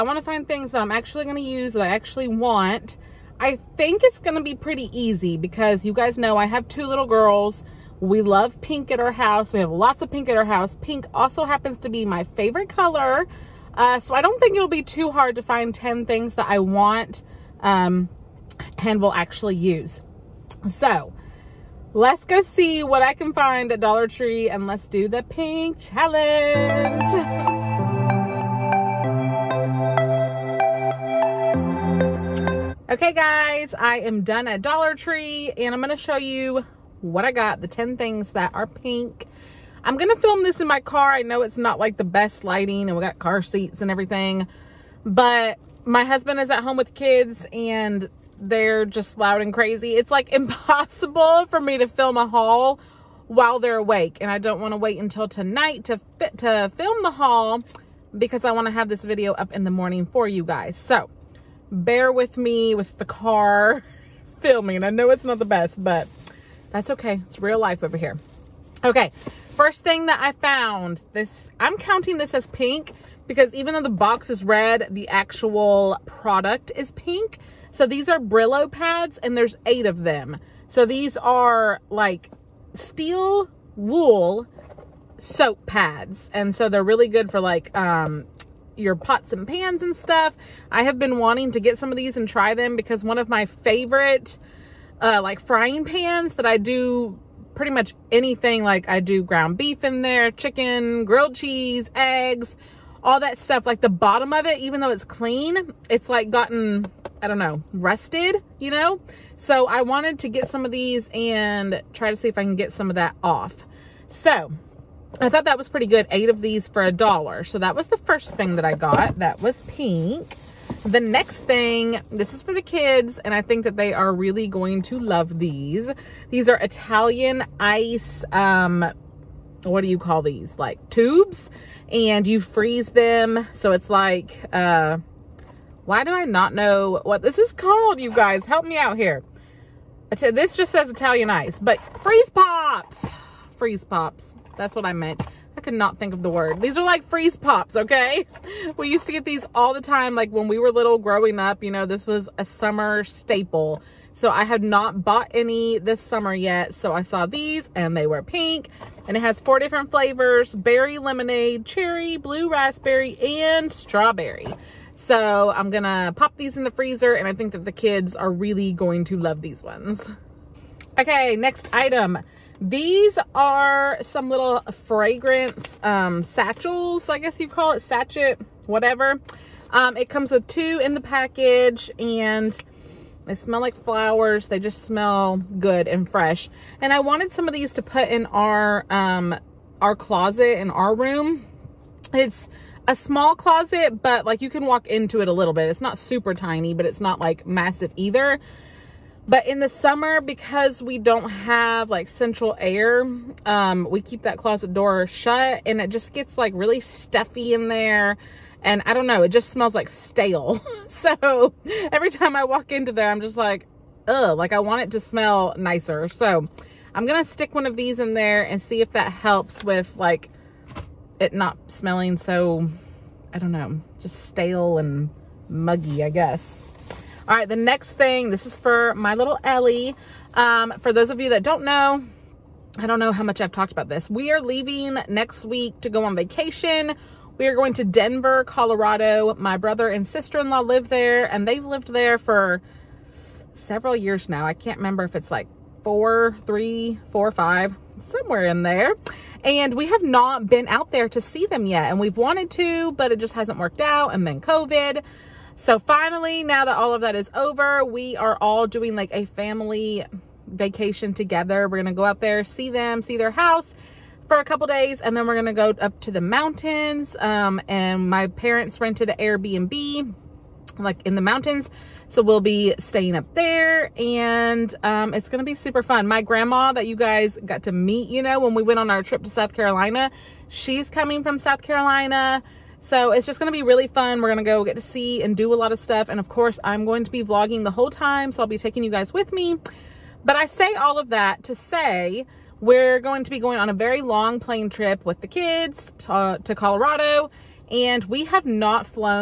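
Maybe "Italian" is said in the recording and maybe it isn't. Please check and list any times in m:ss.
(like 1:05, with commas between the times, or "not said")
2:06, 2:20.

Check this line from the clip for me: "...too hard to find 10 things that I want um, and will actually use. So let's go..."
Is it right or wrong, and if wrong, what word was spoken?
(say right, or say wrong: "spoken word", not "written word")
right.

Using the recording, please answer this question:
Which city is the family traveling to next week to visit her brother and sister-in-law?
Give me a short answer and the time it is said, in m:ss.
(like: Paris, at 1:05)
Denver, Colorado, at 3:57.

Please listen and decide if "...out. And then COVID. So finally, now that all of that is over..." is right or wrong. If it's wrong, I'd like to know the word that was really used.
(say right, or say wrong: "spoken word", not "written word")
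right.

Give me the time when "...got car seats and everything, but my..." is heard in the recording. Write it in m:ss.
0:43.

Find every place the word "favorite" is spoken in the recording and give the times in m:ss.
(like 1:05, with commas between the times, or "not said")
0:12, 1:33.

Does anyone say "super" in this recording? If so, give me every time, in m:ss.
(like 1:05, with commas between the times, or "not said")
3:15, 4:35.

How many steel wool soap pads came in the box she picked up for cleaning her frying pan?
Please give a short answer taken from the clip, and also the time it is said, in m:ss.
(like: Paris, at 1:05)
8, at 1:19.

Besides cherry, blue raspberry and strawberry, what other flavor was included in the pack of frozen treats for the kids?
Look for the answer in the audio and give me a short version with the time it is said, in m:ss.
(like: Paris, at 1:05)
berry lemonade, at 2:40.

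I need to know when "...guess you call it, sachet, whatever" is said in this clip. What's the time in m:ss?
2:57.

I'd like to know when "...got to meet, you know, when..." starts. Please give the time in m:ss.
4:37.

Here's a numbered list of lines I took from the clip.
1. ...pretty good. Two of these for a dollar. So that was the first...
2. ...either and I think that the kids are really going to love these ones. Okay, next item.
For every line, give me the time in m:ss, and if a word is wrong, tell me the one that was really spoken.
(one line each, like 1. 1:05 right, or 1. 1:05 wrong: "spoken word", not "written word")
1. 1:55 wrong: "Eight", not "Two"
2. 2:46 wrong: "freezer", not "either".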